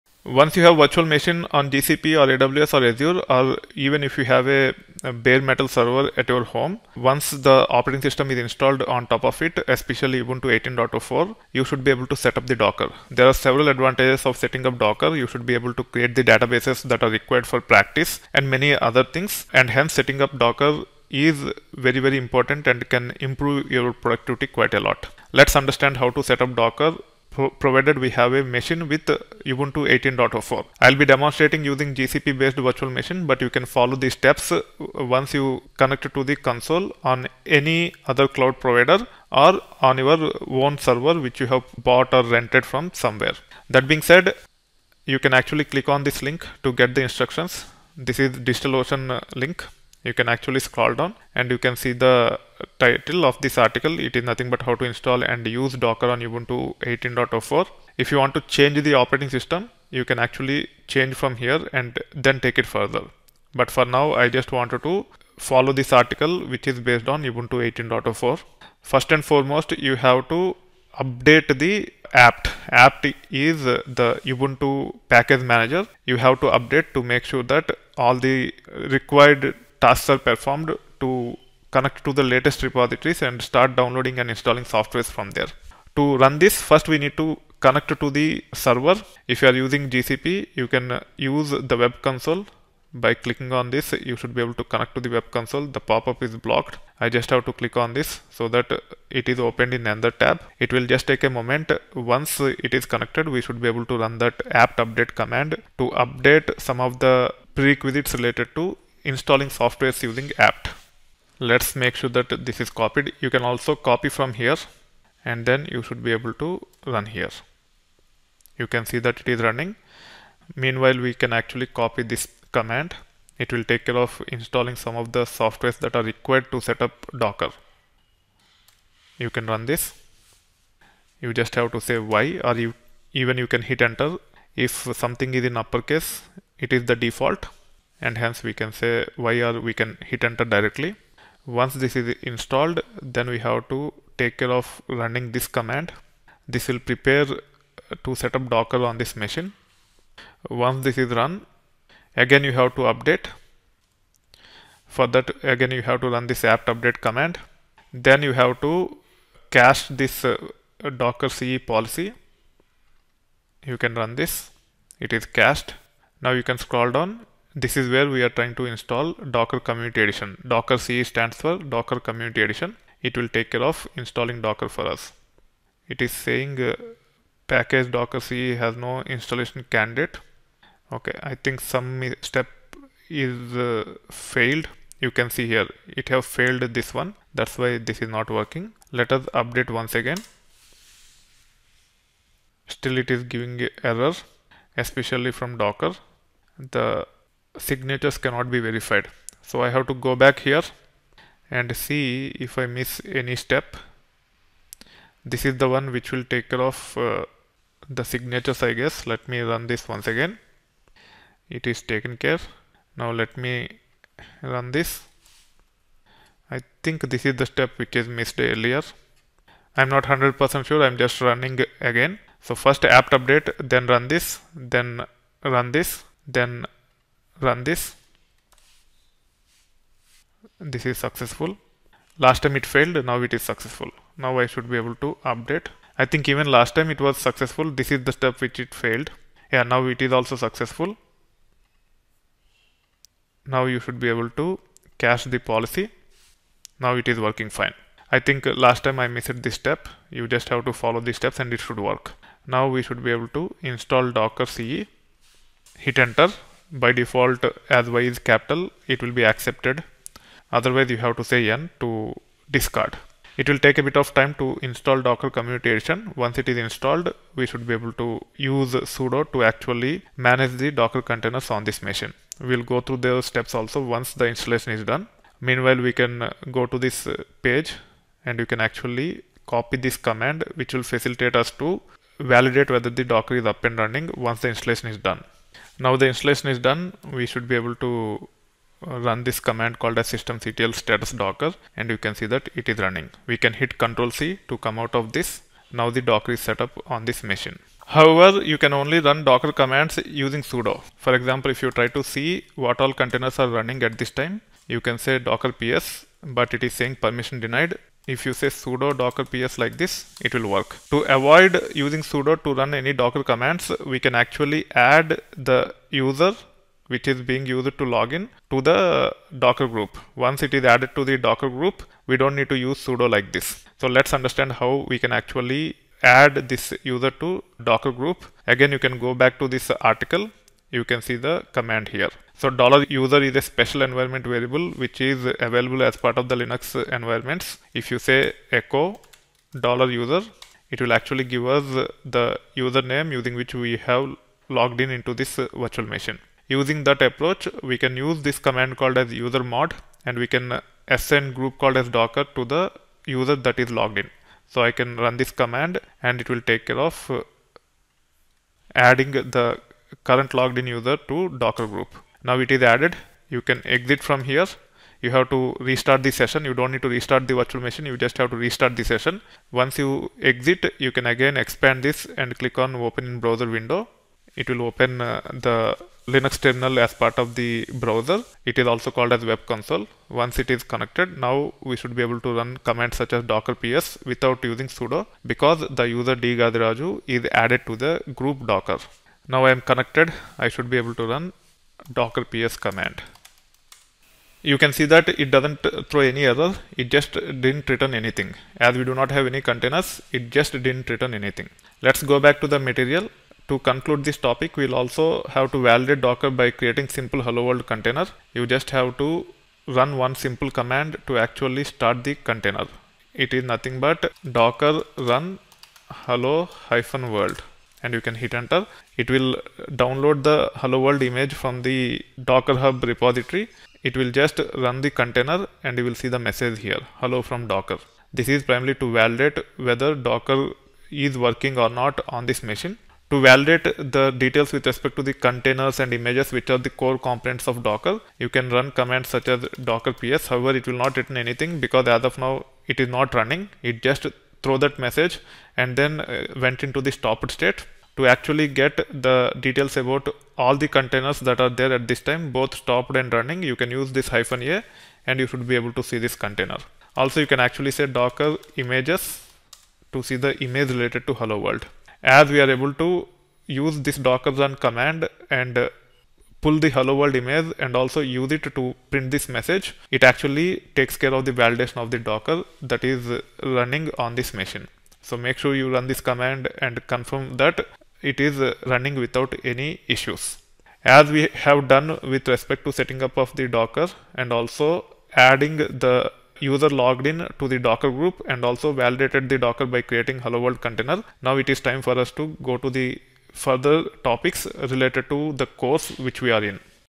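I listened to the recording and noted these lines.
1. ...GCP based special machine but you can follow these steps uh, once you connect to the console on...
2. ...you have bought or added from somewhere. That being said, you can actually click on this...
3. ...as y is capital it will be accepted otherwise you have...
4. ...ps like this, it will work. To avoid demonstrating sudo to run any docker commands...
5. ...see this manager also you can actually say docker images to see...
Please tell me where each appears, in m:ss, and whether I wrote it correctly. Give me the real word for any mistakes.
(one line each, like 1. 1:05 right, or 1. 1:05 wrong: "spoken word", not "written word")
1. 0:31 wrong: "virtual", not "special"
2. 0:41 wrong: "rented", not "added"
3. 4:17 right
4. 5:09 wrong: "using", not "demonstrating"
5. 7:35 wrong: "container", not "manager".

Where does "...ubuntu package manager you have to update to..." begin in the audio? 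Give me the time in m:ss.
1:14.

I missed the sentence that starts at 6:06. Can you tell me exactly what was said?
You don't need to restart the virtual machine.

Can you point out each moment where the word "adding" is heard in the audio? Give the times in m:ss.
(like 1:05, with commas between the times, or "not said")
5:58, 8:05.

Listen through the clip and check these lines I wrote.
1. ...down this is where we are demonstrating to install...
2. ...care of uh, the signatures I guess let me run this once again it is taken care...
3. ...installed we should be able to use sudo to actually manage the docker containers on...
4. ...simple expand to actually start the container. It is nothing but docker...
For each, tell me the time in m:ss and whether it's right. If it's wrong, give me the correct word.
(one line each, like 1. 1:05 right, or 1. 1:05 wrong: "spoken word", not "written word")
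1. 2:46 wrong: "trying", not "demonstrating"
2. 3:26 right
3. 4:26 right
4. 6:50 wrong: "command", not "expand".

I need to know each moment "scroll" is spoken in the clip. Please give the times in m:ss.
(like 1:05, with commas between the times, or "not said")
0:50, 2:46.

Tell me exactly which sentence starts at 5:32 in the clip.
So dollar $user is a special environment variable which is available as part of the Linux environments.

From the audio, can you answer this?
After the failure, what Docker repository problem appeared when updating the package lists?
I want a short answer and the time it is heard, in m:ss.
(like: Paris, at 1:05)
signatures cannot be verified, at 3:16.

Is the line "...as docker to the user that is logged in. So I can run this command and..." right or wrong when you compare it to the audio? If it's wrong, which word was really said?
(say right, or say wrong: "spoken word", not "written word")
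right.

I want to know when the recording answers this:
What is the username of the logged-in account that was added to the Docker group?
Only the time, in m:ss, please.
6:26.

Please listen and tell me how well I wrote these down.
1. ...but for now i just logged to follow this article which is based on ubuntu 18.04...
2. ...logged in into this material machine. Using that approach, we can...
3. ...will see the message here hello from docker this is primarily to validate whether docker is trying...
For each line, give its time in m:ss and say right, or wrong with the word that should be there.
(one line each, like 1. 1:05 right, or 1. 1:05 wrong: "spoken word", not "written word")
1. 1:03 wrong: "wanted", not "logged"
2. 5:44 wrong: "virtual", not "material"
3. 7:05 wrong: "working", not "trying".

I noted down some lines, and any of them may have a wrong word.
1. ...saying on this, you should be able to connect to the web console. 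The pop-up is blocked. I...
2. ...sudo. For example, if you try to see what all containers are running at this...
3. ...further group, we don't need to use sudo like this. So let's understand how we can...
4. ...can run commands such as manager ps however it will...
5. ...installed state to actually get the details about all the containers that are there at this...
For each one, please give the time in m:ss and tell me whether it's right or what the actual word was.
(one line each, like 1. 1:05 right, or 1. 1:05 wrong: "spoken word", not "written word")
1. 1:33 wrong: "clicking", not "saying"
2. 5:00 right
3. 5:21 wrong: "docker", not "further"
4. 7:18 wrong: "docker", not "manager"
5. 7:26 wrong: "stopped", not "installed".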